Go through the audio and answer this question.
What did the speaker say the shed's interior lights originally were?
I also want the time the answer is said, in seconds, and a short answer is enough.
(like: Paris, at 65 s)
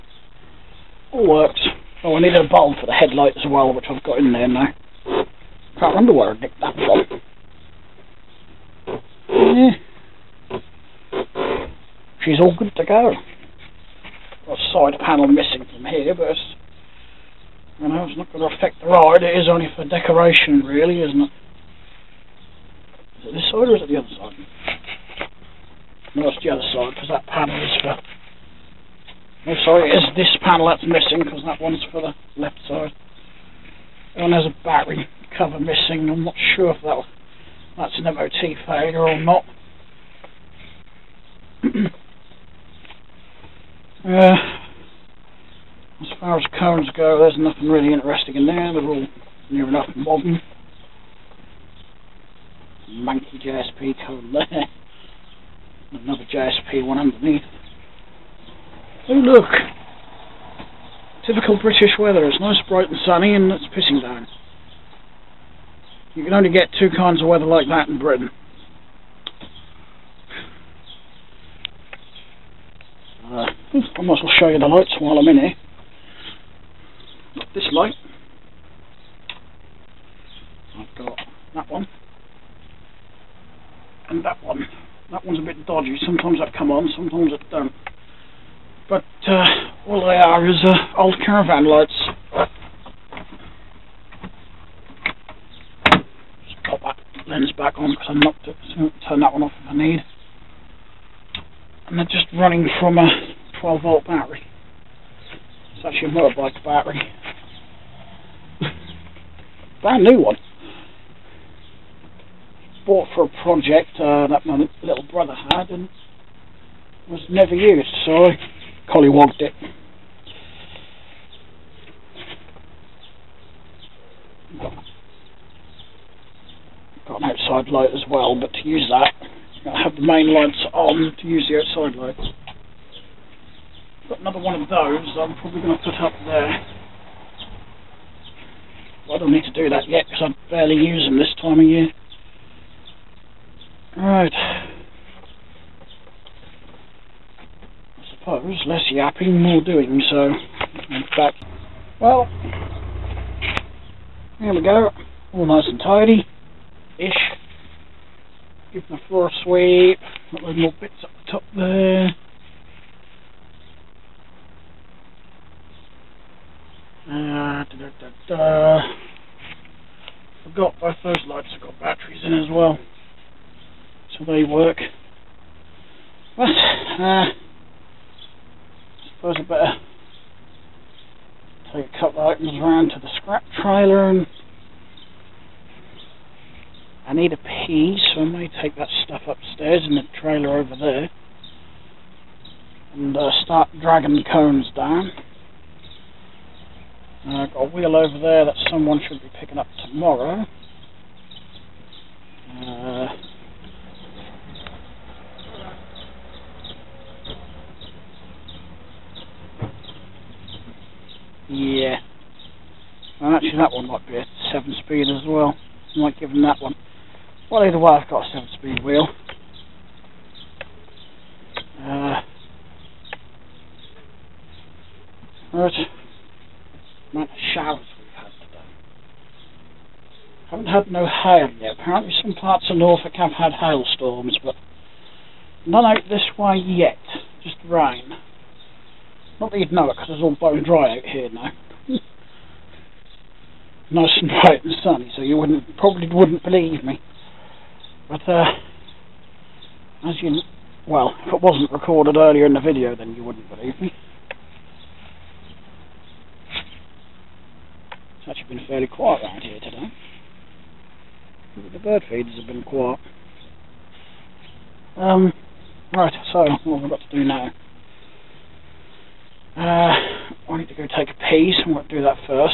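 old caravan lights, at 90 s.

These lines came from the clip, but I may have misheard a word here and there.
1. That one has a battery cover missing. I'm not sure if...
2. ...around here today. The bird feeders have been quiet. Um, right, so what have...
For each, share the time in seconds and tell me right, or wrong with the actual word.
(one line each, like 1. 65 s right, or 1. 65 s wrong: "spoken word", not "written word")
1. 34 s right
2. 259 s right.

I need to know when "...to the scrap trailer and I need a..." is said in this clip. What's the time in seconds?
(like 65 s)
182 s.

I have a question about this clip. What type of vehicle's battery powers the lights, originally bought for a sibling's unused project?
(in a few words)
motorbike.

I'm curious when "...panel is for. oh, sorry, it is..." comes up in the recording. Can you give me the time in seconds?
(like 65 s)
27 s.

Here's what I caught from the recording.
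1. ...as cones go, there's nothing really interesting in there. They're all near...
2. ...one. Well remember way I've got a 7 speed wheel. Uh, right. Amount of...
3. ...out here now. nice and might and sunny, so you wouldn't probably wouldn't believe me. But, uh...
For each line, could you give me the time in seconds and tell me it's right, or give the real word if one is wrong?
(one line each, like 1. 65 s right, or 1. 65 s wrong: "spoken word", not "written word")
1. 46 s right
2. 216 s wrong: "either", not "remember"
3. 240 s wrong: "bright", not "might".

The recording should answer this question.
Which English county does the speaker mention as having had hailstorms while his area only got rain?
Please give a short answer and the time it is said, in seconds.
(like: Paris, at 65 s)
Norfolk, at 232 s.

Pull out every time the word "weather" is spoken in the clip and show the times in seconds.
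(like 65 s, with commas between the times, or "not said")
61 s, 67 s.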